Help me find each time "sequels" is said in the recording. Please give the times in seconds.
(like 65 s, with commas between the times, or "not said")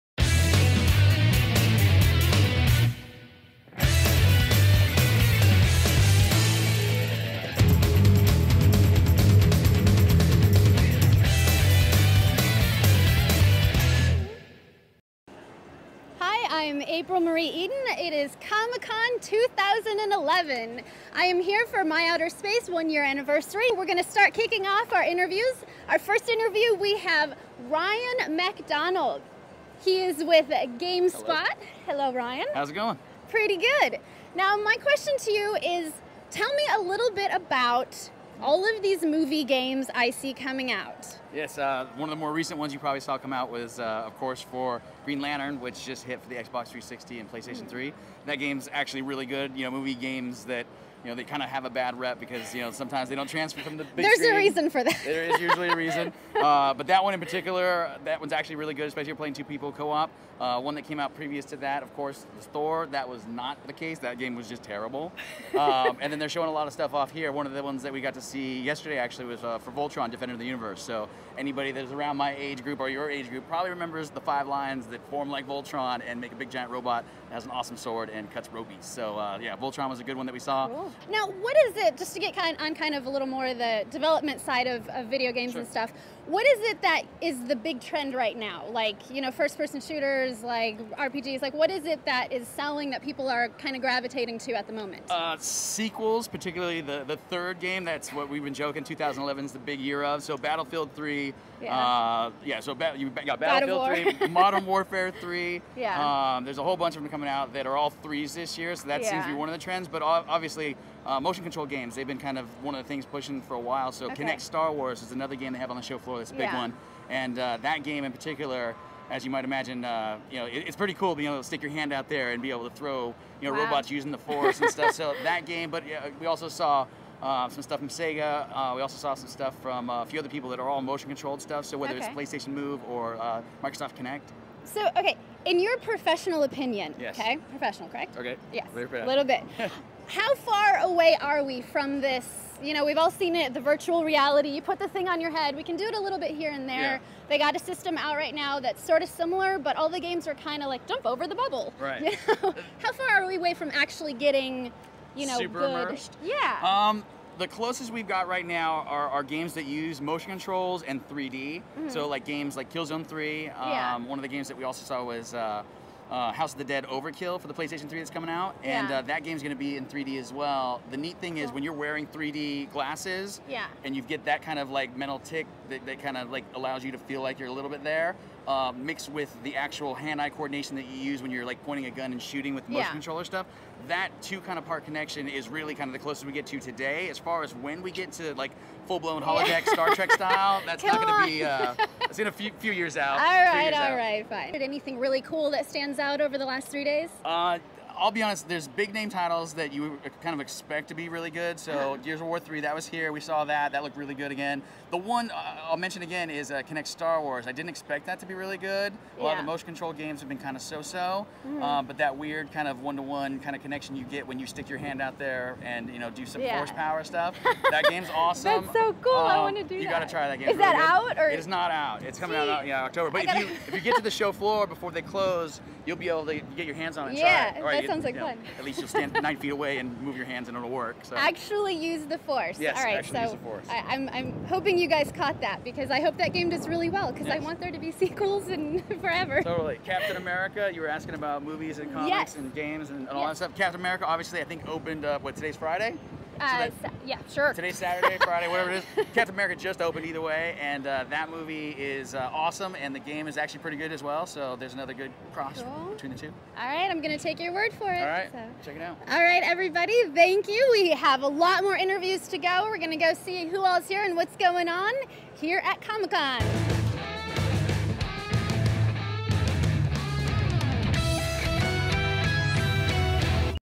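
95 s, 237 s.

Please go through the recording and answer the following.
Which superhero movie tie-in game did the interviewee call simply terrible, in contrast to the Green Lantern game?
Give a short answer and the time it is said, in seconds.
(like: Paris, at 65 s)
Thor, at 62 s.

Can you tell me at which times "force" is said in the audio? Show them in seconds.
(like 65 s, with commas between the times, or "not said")
124 s, 216 s, 232 s.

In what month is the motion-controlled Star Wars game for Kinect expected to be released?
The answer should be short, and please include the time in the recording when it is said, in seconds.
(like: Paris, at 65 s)
October, at 222 s.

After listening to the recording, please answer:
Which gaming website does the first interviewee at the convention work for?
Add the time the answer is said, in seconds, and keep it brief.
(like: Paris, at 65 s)
GameSpot, at 30 s.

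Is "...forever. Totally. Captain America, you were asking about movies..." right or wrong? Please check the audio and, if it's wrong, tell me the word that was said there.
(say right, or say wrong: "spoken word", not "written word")
right.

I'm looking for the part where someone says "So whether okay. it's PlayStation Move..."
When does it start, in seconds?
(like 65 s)
131 s.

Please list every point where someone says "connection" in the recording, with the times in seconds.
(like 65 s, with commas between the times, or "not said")
184 s, 213 s.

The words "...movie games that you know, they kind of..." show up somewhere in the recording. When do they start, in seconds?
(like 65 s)
49 s.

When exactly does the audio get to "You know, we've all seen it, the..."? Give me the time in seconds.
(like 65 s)
142 s.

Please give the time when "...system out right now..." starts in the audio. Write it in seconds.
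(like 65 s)
147 s.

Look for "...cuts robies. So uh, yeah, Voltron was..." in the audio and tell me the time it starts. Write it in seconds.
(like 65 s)
78 s.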